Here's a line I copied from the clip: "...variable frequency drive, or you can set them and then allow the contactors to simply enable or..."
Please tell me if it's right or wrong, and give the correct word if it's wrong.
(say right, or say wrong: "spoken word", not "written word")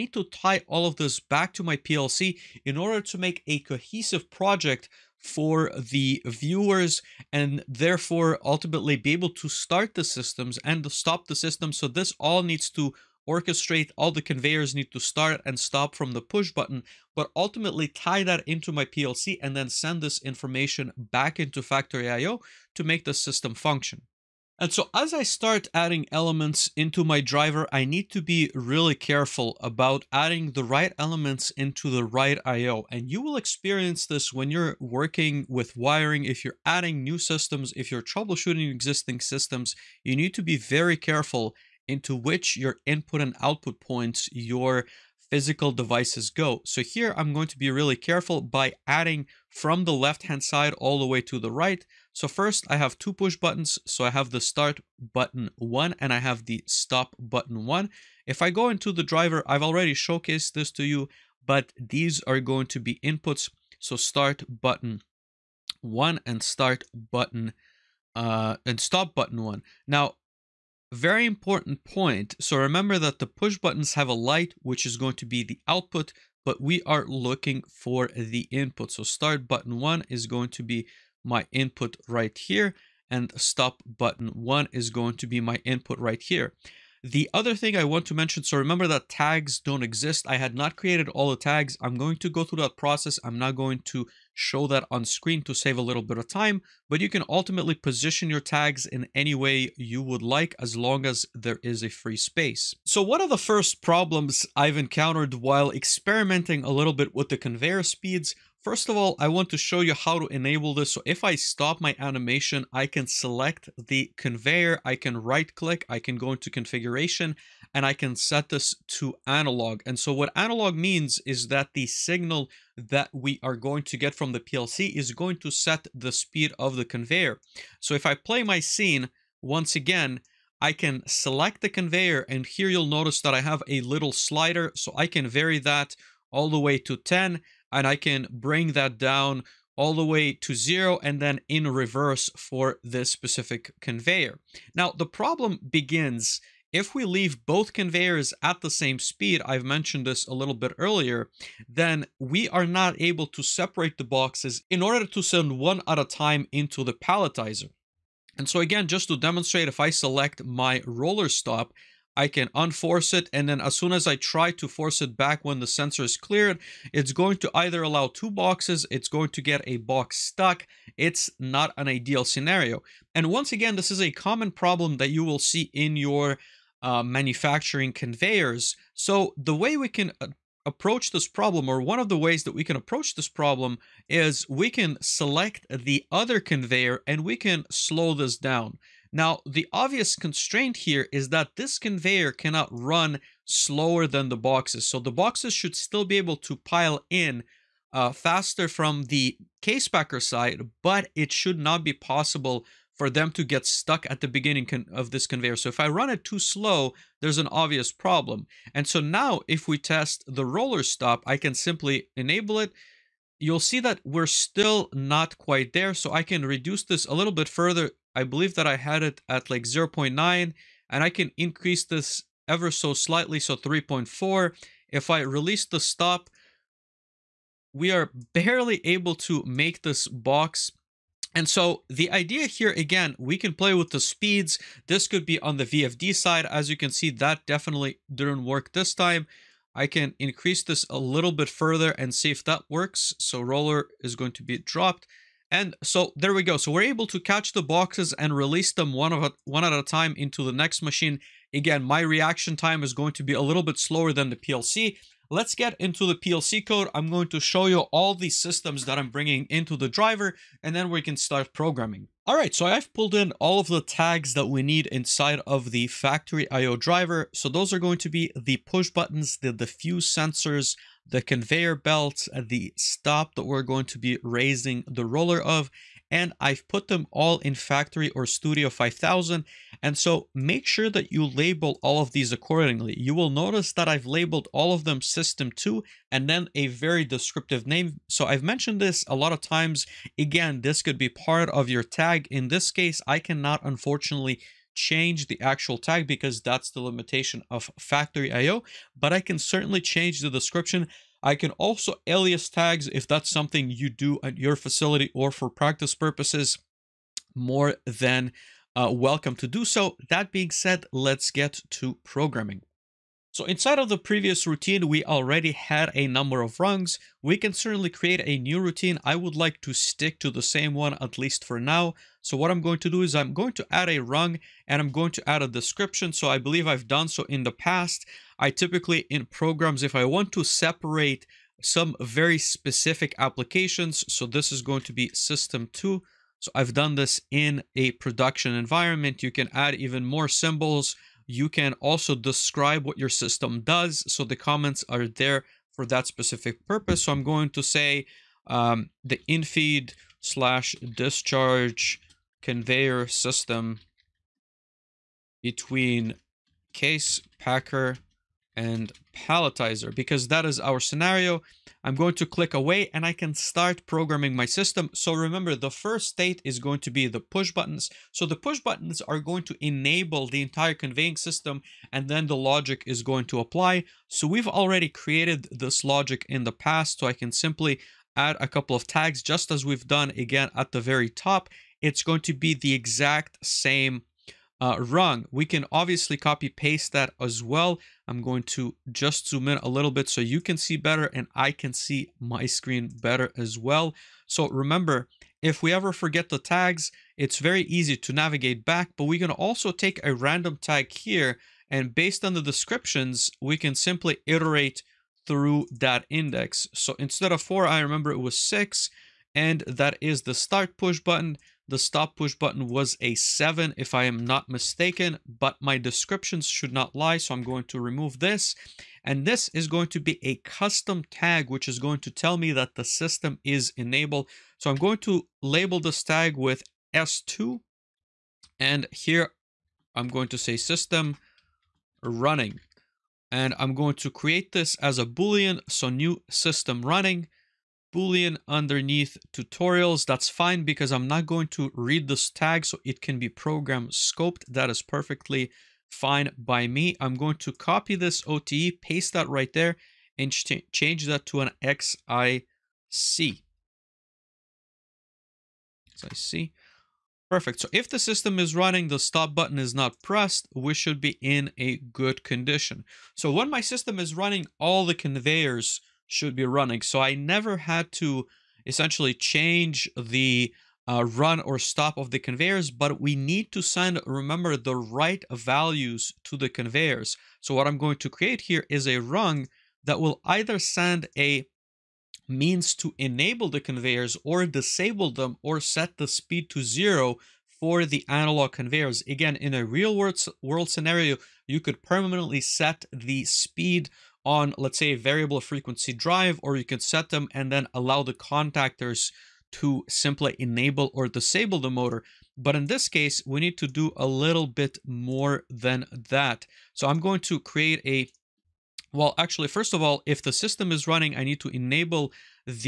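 right.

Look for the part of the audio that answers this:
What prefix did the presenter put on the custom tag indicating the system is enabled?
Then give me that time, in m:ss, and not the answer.
7:06.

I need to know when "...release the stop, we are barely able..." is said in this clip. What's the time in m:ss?
3:45.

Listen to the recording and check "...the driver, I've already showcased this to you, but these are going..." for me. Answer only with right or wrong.
right.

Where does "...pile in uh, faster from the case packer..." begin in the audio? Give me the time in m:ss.
3:16.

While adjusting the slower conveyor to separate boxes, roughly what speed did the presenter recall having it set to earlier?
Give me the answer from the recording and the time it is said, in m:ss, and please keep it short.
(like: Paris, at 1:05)
0.9, at 3:39.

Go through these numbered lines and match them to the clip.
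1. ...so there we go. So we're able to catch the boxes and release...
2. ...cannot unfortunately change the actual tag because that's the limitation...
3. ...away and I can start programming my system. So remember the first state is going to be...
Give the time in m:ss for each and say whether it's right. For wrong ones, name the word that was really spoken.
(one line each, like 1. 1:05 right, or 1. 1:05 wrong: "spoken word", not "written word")
1. 4:05 right
2. 4:53 right
3. 6:02 right.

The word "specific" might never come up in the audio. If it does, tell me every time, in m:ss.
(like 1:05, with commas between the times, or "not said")
2:23, 5:32, 5:46.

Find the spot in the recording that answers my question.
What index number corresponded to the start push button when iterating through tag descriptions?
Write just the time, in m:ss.
6:48.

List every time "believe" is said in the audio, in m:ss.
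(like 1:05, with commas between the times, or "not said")
3:38, 5:26.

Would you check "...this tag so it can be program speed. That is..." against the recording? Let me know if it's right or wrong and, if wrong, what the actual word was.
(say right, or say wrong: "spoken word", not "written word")
wrong: "scoped", not "speed".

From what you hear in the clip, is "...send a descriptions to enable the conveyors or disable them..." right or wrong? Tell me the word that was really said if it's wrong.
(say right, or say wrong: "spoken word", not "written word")
wrong: "means", not "descriptions".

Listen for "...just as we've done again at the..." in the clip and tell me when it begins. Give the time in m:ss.
6:19.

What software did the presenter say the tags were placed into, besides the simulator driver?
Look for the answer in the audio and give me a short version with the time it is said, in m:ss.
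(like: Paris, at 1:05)
Studio 5000, at 4:38.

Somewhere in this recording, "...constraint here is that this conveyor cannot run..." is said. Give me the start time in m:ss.
3:10.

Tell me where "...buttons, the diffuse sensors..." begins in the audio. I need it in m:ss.
4:28.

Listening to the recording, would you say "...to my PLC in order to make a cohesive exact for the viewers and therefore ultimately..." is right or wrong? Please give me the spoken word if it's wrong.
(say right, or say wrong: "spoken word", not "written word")
wrong: "project", not "exact".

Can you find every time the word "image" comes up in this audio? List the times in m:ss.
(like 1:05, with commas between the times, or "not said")
not said.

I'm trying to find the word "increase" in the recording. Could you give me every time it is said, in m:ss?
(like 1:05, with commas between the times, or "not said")
3:41, 4:00.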